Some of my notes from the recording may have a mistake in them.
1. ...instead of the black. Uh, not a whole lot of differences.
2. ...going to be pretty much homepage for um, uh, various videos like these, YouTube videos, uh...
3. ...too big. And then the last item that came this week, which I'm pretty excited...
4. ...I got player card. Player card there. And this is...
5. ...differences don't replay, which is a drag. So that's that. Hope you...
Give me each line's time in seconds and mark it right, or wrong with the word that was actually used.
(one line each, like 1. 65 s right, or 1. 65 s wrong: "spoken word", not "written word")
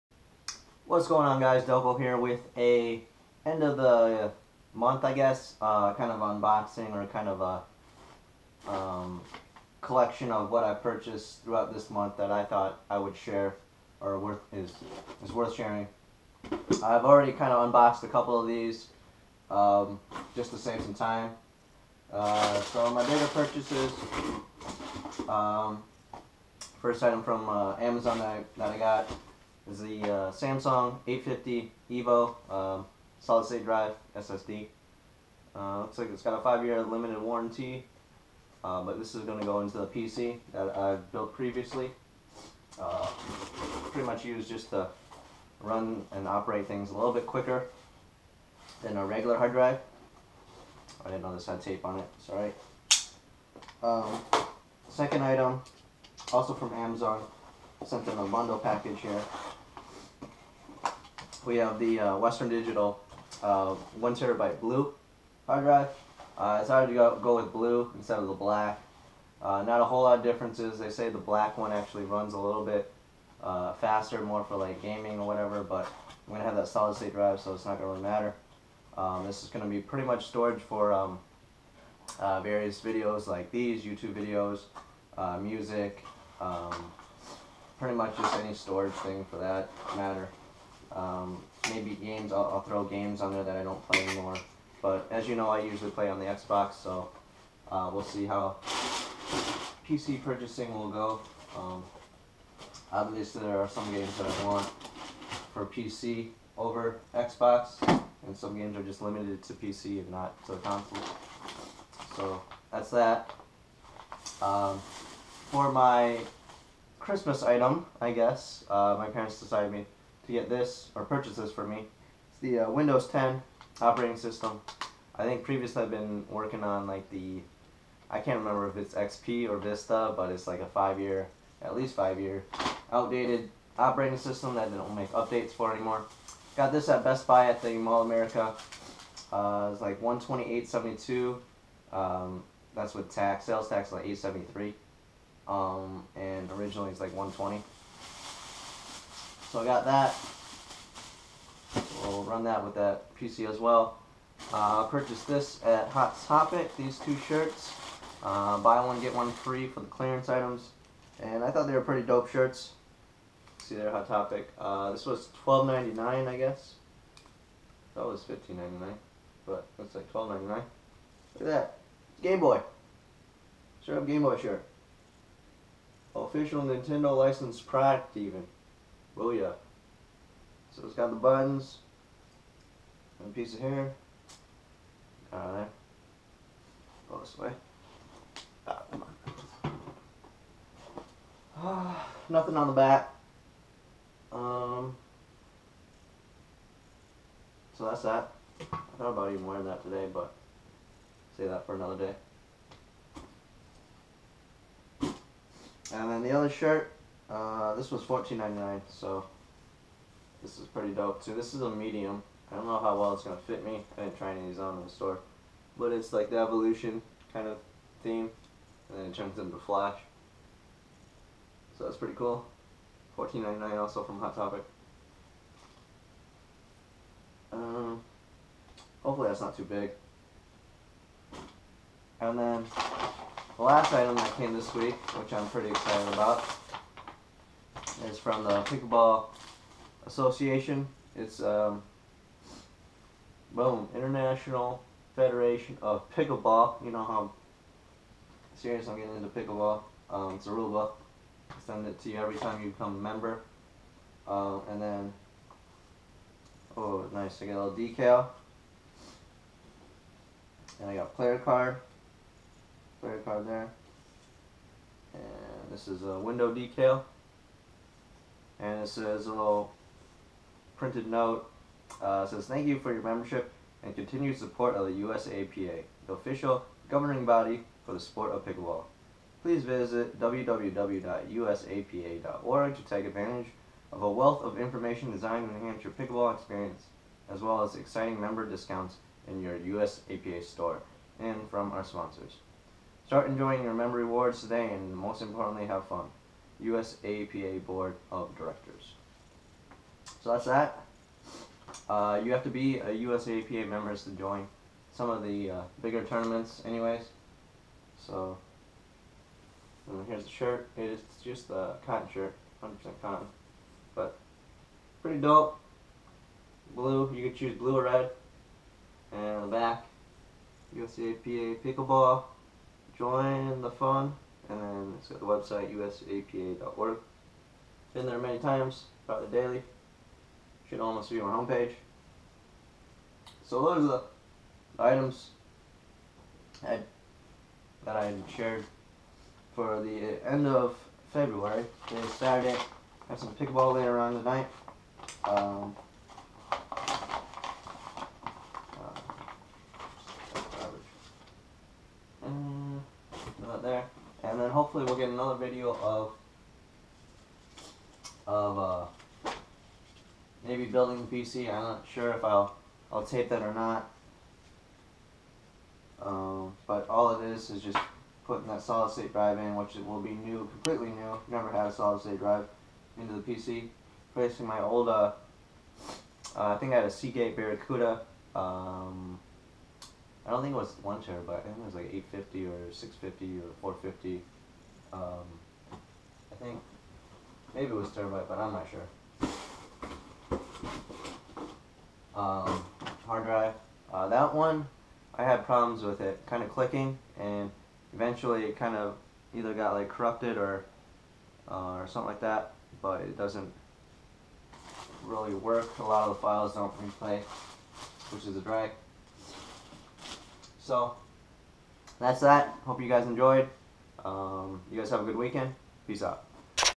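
1. 67 s right
2. 79 s wrong: "storage", not "homepage"
3. 229 s right
4. 260 s right
5. 406 s wrong: "files", not "differences".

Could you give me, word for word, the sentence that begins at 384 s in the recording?
Um, I think maybe it was terabyte, but I'm not sure.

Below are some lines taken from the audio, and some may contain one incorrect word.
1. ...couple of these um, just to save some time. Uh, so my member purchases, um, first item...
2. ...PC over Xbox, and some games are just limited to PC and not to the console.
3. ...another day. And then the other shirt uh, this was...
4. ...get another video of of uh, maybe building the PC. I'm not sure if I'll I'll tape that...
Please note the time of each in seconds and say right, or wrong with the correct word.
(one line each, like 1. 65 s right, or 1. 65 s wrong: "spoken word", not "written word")
1. 18 s wrong: "bigger", not "member"
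2. 105 s right
3. 201 s right
4. 354 s right.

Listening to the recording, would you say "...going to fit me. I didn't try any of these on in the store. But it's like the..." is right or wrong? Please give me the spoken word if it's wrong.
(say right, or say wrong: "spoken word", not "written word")
right.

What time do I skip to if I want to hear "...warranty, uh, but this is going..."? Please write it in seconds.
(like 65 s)
37 s.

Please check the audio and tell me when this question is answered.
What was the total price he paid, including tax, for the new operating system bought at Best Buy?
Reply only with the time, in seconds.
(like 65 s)
140 s.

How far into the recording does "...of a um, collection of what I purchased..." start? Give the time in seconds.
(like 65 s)
7 s.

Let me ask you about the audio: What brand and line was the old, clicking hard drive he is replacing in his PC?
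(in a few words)
Seagate Barracuda.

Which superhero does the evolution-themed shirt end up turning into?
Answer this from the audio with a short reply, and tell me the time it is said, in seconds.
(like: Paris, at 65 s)
Flash, at 219 s.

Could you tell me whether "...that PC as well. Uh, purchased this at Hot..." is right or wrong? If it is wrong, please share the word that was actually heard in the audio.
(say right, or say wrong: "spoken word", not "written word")
right.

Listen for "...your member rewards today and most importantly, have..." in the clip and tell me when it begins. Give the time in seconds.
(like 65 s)
293 s.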